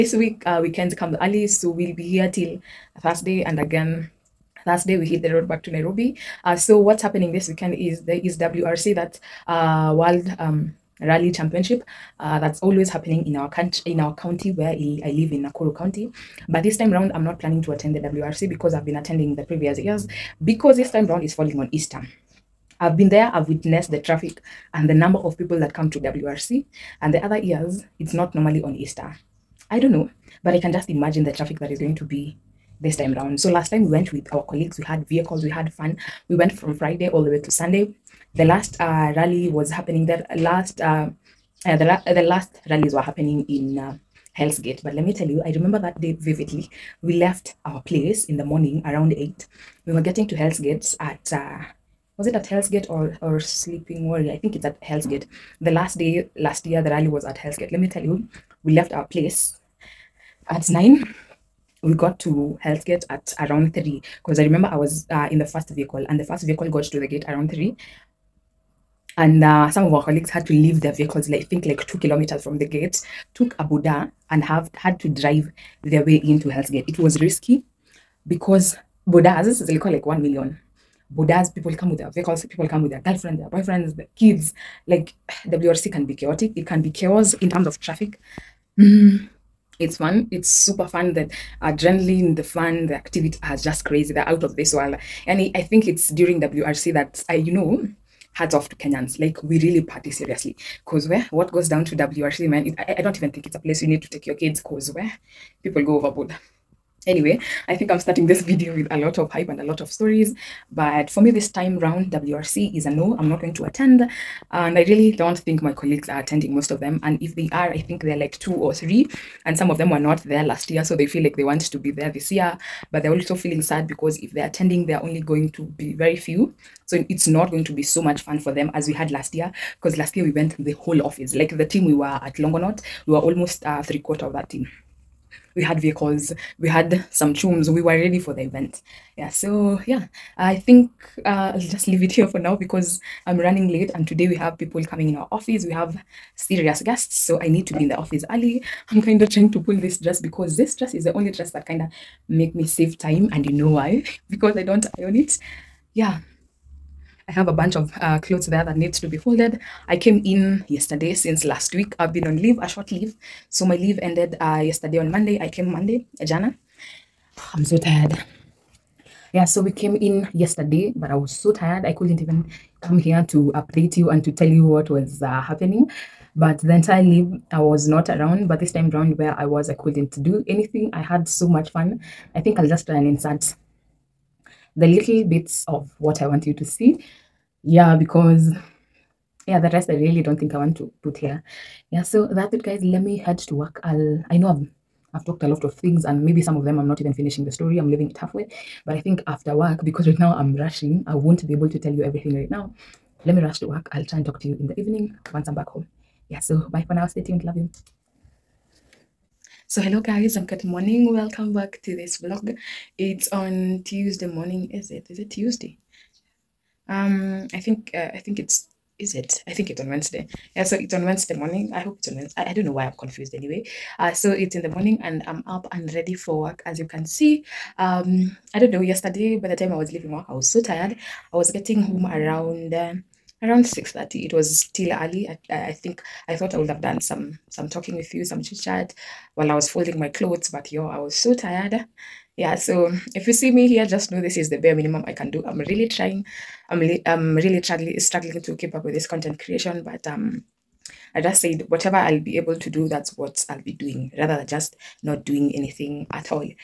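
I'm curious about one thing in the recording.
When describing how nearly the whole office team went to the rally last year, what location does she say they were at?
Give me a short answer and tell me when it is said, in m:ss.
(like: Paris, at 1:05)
Longonot, at 2:12.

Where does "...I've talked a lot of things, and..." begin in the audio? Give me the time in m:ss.
3:15.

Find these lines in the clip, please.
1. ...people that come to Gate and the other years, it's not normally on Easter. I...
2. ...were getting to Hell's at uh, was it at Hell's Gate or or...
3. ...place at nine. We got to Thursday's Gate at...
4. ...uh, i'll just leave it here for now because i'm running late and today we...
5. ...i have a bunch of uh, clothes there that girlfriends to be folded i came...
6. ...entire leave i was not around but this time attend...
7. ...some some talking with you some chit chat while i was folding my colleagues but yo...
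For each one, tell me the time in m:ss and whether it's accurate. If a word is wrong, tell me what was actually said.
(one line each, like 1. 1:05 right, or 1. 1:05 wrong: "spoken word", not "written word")
1. 0:25 wrong: "WRC", not "Gate"
2. 0:49 right
3. 0:59 wrong: "Hell", not "Thursday"
4. 2:21 right
5. 2:37 wrong: "needs", not "girlfriends"
6. 2:56 wrong: "round", not "attend"
7. 3:57 wrong: "clothes", not "colleagues".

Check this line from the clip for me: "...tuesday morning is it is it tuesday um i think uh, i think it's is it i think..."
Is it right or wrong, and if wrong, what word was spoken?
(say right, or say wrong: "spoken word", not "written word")
right.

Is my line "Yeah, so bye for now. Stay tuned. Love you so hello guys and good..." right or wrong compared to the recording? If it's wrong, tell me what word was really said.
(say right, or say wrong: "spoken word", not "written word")
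right.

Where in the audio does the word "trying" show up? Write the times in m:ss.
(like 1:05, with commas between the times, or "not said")
2:29, 4:05.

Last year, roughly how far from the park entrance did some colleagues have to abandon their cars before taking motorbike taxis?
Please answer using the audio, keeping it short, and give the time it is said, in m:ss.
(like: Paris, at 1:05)
2 kilometers, at 1:11.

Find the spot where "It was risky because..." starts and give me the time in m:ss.
1:16.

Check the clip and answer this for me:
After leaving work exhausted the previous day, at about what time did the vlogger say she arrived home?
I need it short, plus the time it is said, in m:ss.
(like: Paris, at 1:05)
6:30, at 3:53.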